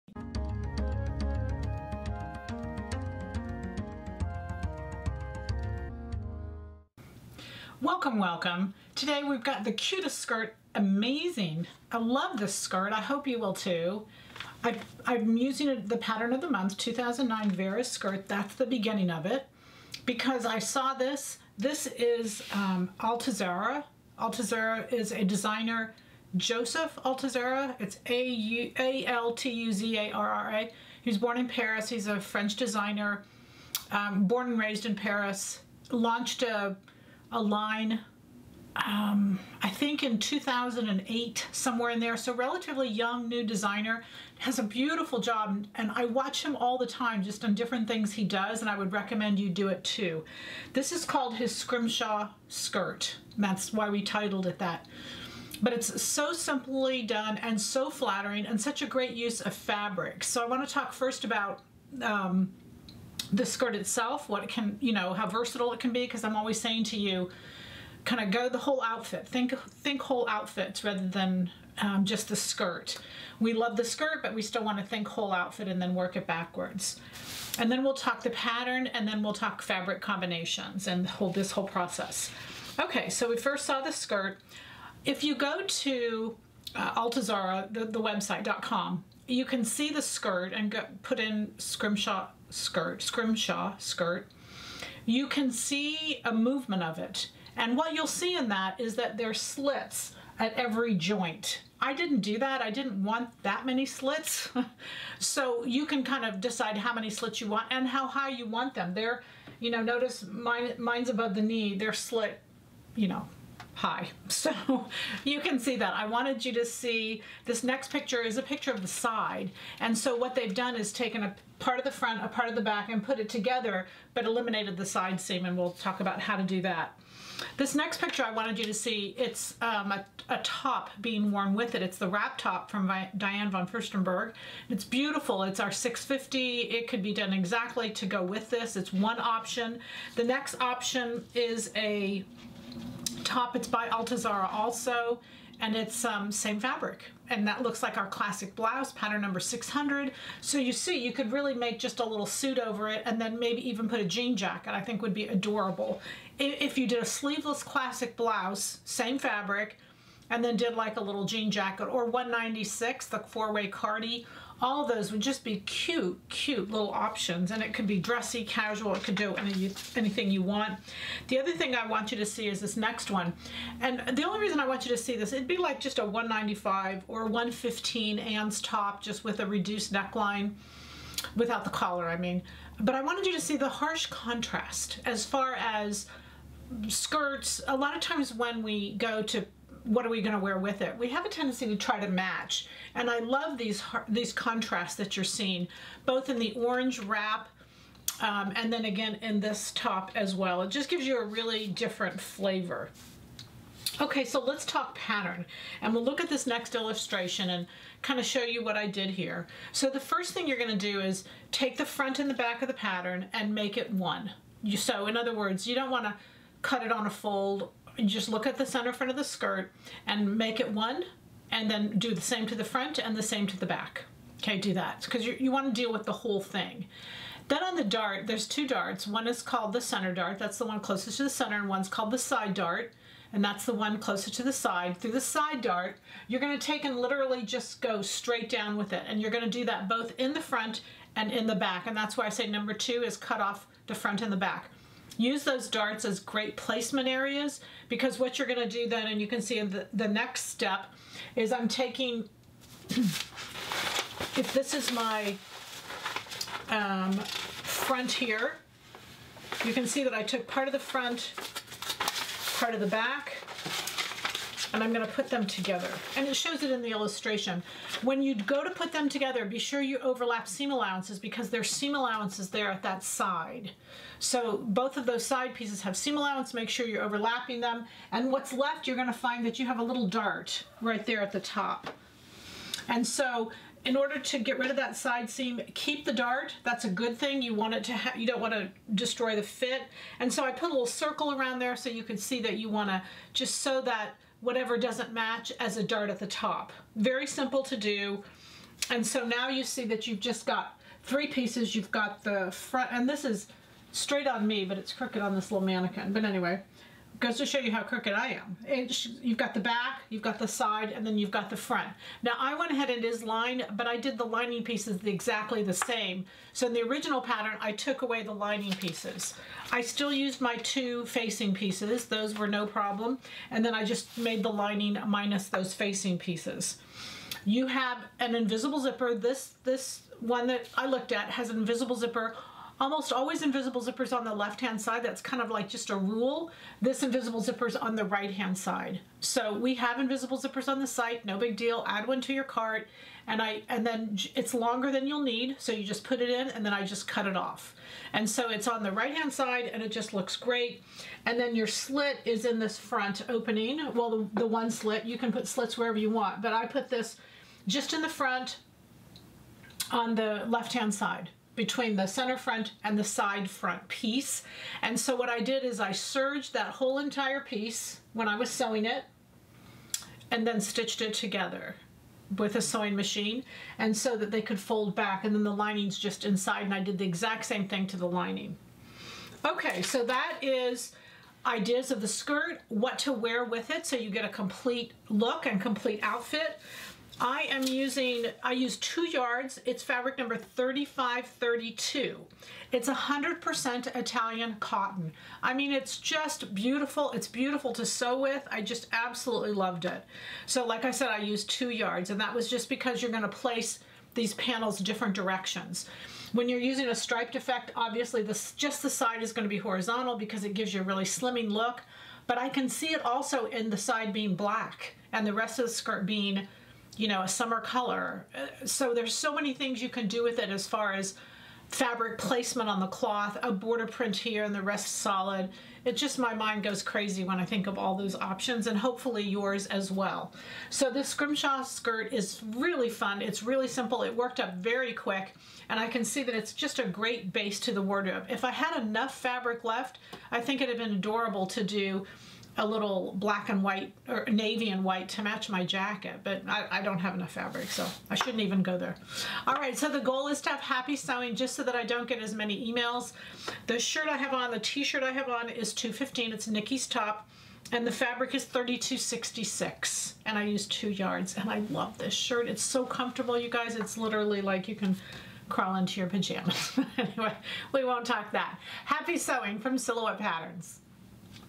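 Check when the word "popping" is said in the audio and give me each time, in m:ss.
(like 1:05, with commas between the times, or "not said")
not said.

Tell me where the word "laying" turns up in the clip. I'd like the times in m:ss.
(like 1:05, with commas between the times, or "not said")
not said.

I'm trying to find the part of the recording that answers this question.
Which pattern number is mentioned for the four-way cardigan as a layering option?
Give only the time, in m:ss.
2:42.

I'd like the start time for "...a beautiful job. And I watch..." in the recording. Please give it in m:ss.
0:44.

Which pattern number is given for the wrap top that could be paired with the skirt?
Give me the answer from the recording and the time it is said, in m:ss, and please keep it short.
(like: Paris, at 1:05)
650, at 2:15.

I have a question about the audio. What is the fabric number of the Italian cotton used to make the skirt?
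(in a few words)
3532.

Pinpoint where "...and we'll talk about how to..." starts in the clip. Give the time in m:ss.
2:05.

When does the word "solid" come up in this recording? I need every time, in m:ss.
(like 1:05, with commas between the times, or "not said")
7:04.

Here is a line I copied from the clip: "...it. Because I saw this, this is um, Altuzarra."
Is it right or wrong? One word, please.
right.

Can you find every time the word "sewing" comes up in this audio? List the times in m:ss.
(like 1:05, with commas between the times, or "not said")
6:08, 6:12, 7:30, 7:49.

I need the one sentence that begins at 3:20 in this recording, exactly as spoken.
It just gives you a really different flavor.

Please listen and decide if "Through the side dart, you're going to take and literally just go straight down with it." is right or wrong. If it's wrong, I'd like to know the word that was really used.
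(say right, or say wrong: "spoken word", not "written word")
right.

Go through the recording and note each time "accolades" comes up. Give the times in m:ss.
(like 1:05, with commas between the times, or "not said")
not said.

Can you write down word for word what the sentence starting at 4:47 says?
You want it to you don't want to destroy the fit.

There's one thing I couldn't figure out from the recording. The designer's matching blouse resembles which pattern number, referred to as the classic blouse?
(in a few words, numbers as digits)
600.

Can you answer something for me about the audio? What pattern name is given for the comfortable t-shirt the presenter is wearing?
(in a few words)
Nikki's top.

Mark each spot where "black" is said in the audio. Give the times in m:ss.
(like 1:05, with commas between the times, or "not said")
6:54, 7:23.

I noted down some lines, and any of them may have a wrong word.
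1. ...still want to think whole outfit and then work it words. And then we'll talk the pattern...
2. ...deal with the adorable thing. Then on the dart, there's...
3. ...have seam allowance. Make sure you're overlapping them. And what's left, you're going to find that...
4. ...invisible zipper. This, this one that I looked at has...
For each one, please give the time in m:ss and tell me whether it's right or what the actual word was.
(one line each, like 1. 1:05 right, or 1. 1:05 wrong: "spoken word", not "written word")
1. 1:14 wrong: "backwards", not "words"
2. 3:45 wrong: "whole", not "adorable"
3. 4:35 right
4. 5:28 right.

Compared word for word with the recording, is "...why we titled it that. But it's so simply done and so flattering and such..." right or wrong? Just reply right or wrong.
right.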